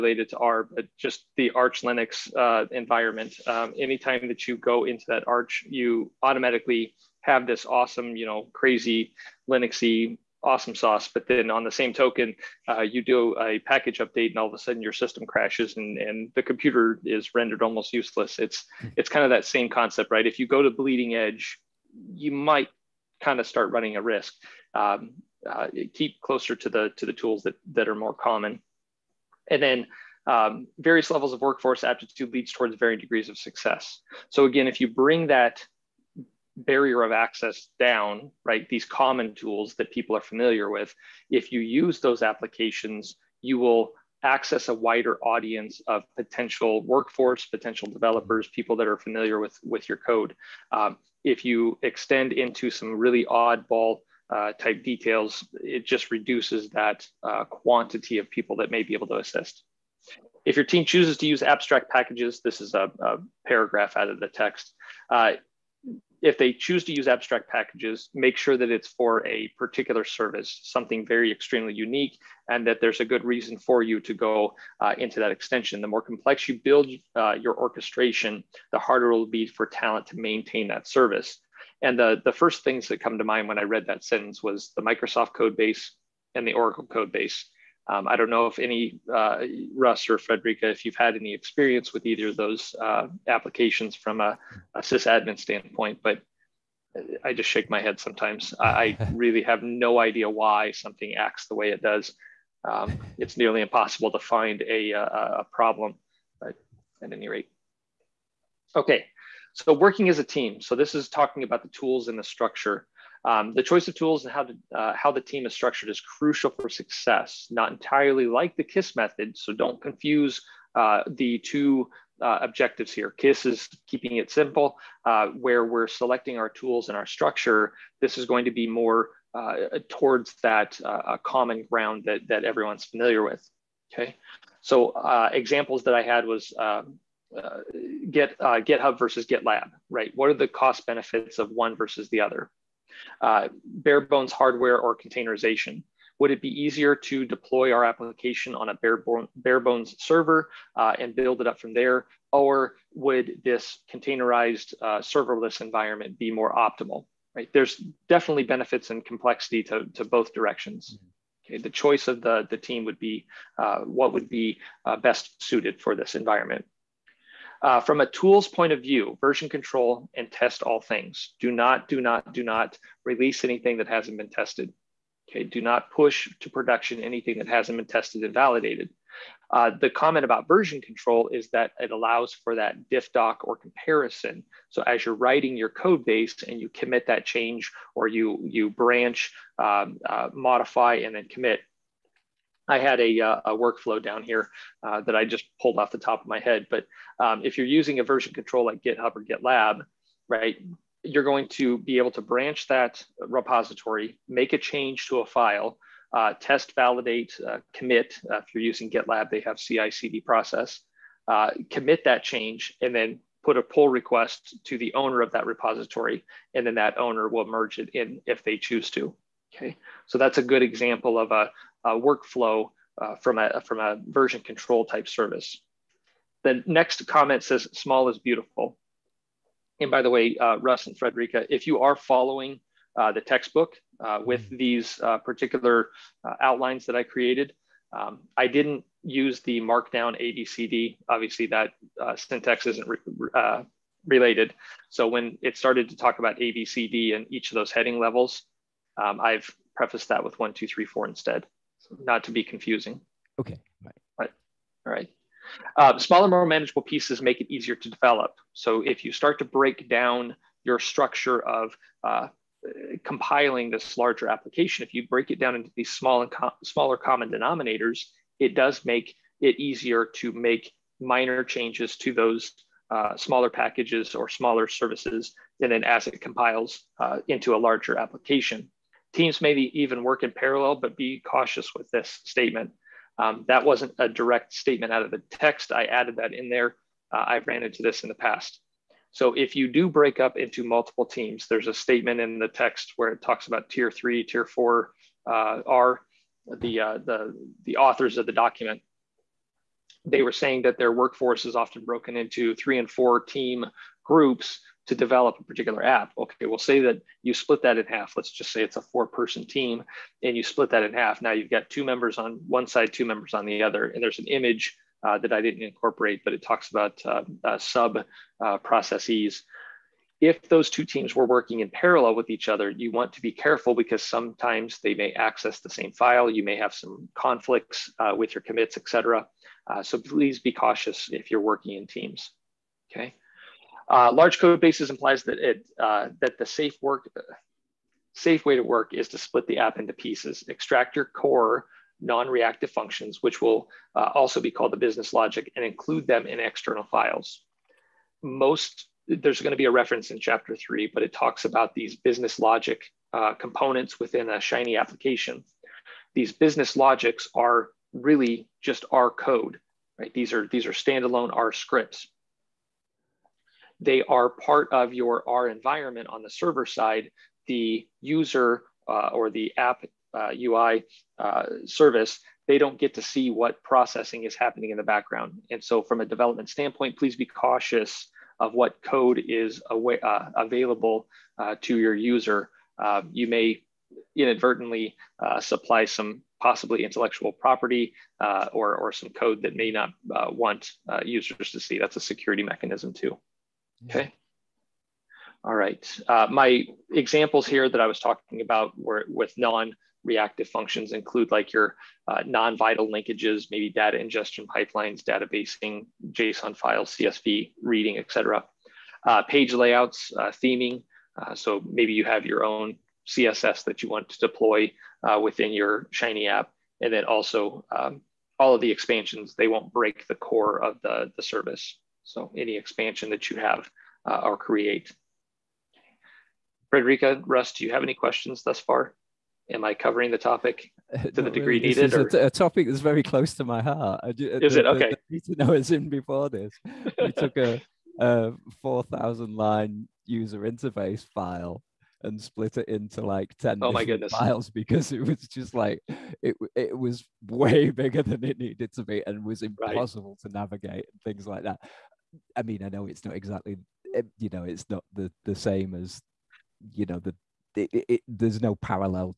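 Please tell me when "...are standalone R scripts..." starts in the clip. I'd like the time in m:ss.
6:00.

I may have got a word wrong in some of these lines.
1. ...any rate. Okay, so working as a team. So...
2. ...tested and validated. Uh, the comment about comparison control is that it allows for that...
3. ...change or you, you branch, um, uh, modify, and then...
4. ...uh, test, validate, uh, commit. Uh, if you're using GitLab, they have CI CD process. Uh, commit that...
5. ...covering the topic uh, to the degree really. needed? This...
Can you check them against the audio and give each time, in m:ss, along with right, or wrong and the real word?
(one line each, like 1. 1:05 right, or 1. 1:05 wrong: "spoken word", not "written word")
1. 1:47 right
2. 2:57 wrong: "version", not "comparison"
3. 3:07 right
4. 3:26 right
5. 7:09 right.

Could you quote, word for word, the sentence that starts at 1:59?
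So don't confuse uh, the two uh, objectives here.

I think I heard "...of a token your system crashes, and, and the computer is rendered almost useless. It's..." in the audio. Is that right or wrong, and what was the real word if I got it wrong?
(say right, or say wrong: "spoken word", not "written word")
wrong: "sudden", not "token".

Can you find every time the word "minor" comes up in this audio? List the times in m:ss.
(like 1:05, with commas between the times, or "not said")
4:31.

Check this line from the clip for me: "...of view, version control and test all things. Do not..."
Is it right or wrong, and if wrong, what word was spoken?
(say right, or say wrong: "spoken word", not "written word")
right.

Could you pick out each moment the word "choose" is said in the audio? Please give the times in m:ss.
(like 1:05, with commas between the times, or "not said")
1:00, 1:06, 3:38.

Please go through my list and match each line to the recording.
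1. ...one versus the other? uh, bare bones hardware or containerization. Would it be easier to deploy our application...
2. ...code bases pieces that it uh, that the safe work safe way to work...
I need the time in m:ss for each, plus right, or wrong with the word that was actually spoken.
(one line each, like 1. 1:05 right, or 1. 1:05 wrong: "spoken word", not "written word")
1. 2:21 right
2. 5:34 wrong: "implies", not "pieces".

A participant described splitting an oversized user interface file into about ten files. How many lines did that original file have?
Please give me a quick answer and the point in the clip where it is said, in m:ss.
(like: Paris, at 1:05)
4,000, at 7:18.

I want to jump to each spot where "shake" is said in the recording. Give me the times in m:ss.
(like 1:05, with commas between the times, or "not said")
1:37.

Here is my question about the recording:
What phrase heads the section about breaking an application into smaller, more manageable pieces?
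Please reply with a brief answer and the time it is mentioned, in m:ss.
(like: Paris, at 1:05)
Small is beautiful, at 3:47.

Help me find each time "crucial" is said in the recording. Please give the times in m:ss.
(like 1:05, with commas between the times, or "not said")
1:56.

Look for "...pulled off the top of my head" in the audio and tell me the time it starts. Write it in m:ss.
3:15.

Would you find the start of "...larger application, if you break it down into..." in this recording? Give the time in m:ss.
4:23.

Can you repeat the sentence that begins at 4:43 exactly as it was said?
Um, that wasn't a direct statement out of the text.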